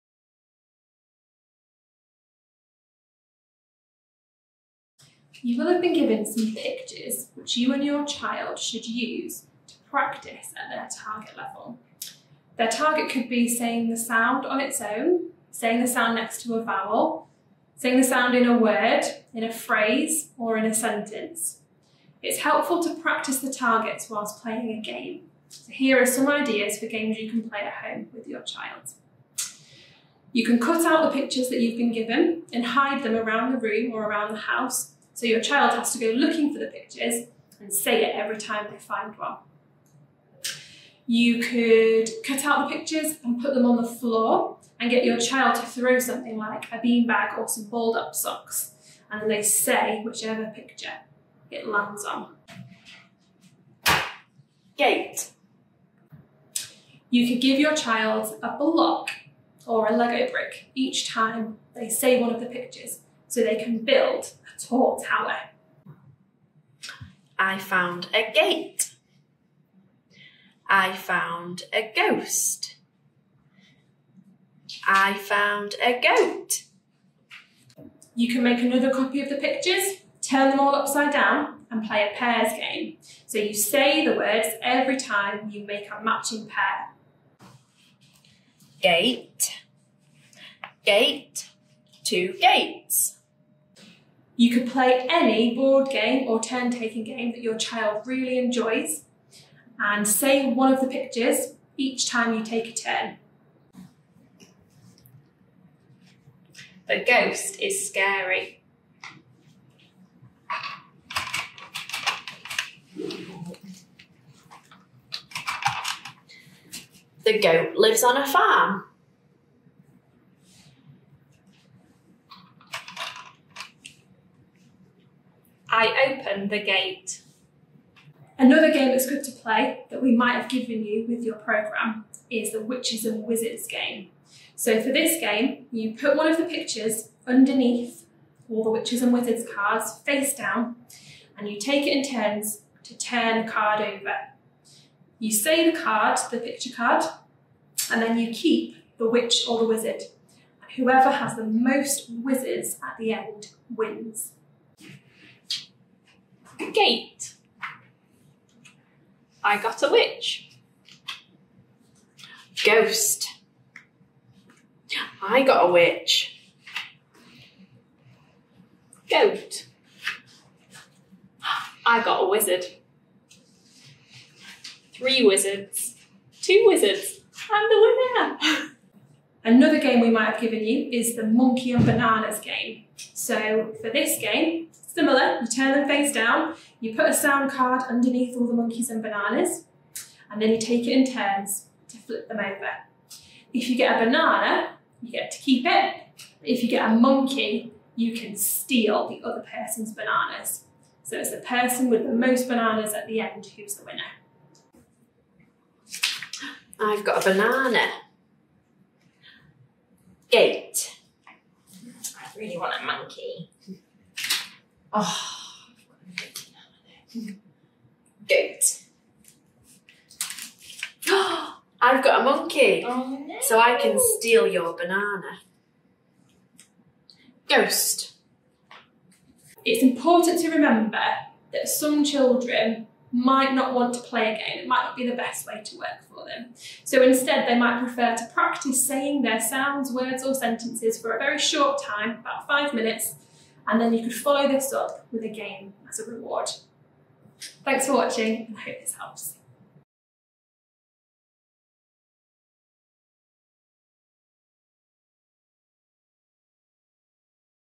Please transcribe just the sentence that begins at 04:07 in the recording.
Thanks for watching and I hope this helps.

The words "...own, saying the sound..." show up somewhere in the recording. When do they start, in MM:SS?
00:14.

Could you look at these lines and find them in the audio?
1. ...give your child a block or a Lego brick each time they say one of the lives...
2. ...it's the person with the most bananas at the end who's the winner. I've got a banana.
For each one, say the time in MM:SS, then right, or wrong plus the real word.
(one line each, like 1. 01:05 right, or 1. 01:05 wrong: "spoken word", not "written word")
1. 00:57 wrong: "pictures", not "lives"
2. 03:21 right.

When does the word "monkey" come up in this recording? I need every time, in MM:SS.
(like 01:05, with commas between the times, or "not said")
03:01, 03:08, 03:16, 03:32, 03:42.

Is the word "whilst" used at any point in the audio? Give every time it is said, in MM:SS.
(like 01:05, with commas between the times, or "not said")
00:24.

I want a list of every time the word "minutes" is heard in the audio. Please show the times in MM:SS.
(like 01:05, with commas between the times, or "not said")
04:02.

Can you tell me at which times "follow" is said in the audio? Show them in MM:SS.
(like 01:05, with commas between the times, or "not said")
04:04.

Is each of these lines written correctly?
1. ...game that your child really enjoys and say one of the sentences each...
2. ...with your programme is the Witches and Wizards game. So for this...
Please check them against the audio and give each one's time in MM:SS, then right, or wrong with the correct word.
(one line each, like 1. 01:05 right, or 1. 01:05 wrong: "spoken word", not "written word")
1. 01:37 wrong: "pictures", not "sentences"
2. 02:11 right.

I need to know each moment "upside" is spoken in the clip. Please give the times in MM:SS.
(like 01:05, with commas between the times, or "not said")
01:20.